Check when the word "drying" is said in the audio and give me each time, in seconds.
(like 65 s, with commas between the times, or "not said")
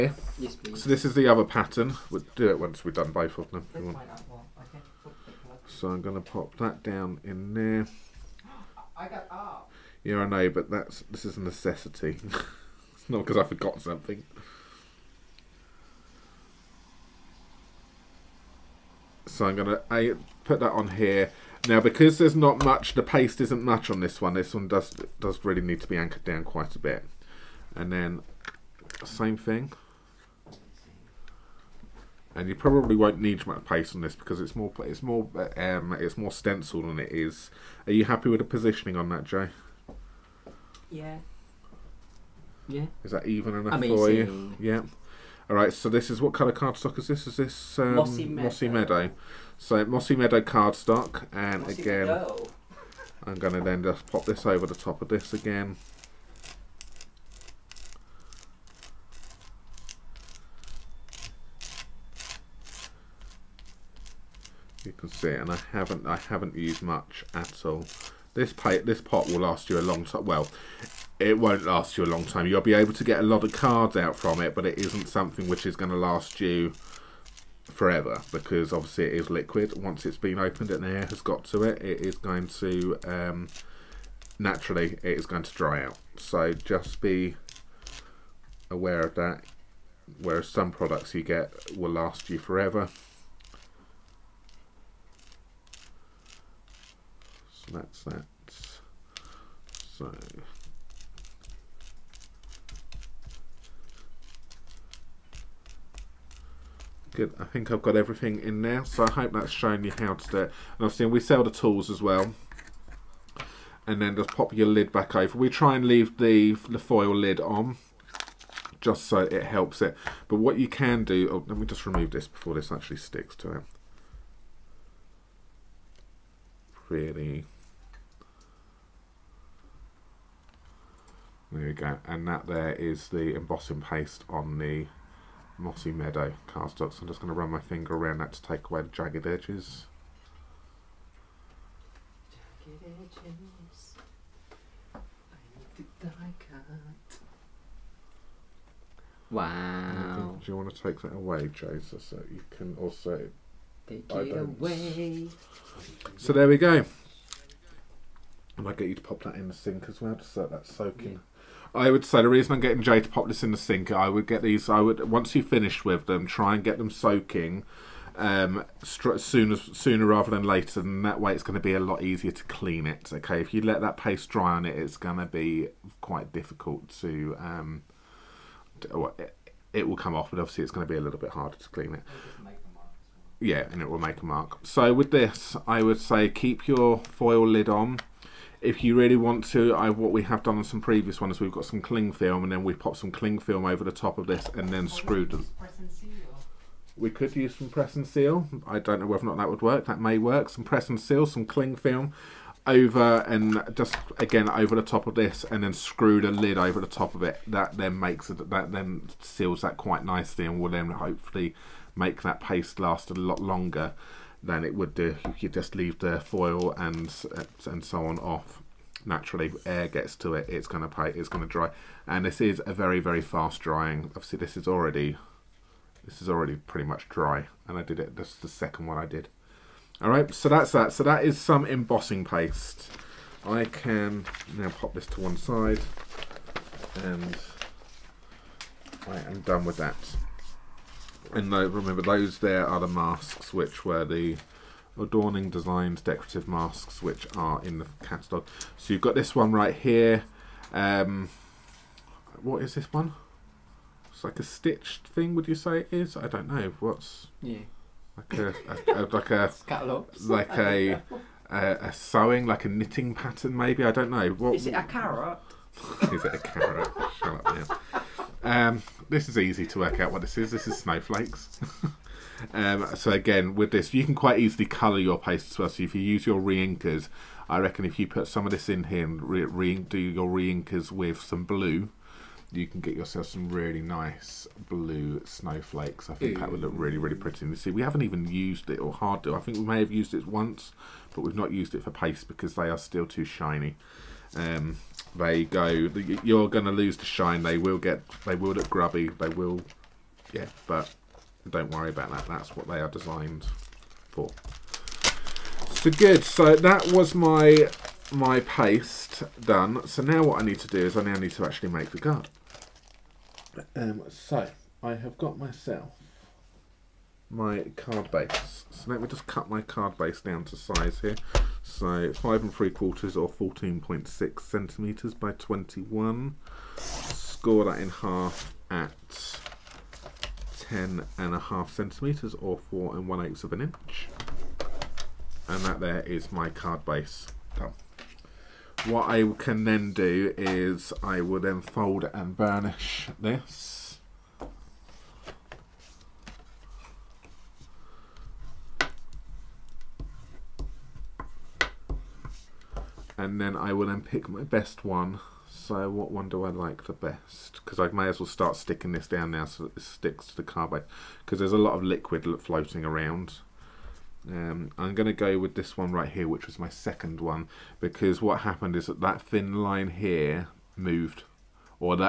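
223 s.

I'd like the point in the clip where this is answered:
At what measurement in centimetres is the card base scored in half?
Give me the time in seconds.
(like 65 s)
330 s.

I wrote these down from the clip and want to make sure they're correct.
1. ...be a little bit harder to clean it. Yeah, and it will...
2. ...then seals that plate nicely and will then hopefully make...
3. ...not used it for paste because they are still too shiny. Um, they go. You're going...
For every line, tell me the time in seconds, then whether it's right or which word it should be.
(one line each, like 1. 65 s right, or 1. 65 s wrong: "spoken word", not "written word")
1. 180 s right
2. 208 s wrong: "quite", not "plate"
3. 291 s right.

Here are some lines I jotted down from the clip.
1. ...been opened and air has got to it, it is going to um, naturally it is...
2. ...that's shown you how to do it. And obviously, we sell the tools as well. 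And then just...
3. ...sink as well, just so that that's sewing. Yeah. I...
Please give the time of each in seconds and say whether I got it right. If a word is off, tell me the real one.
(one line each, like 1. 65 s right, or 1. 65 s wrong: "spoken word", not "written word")
1. 80 s right
2. 109 s right
3. 159 s wrong: "soaking", not "sewing".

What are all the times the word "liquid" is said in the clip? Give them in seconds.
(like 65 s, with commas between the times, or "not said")
79 s, 361 s.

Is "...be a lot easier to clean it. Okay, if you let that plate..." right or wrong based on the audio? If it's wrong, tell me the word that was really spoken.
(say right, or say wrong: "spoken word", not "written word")
wrong: "paste", not "plate".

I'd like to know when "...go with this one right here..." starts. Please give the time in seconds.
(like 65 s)
365 s.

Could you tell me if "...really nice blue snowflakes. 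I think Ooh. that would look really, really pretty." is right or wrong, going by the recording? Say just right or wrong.
right.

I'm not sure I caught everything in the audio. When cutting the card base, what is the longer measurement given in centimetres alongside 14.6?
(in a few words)
21.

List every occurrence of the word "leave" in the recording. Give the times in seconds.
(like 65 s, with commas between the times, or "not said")
115 s, 215 s.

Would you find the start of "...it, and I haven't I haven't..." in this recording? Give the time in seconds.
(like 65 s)
65 s.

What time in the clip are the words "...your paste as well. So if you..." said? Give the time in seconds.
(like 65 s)
274 s.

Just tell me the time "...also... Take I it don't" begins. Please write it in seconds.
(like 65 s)
152 s.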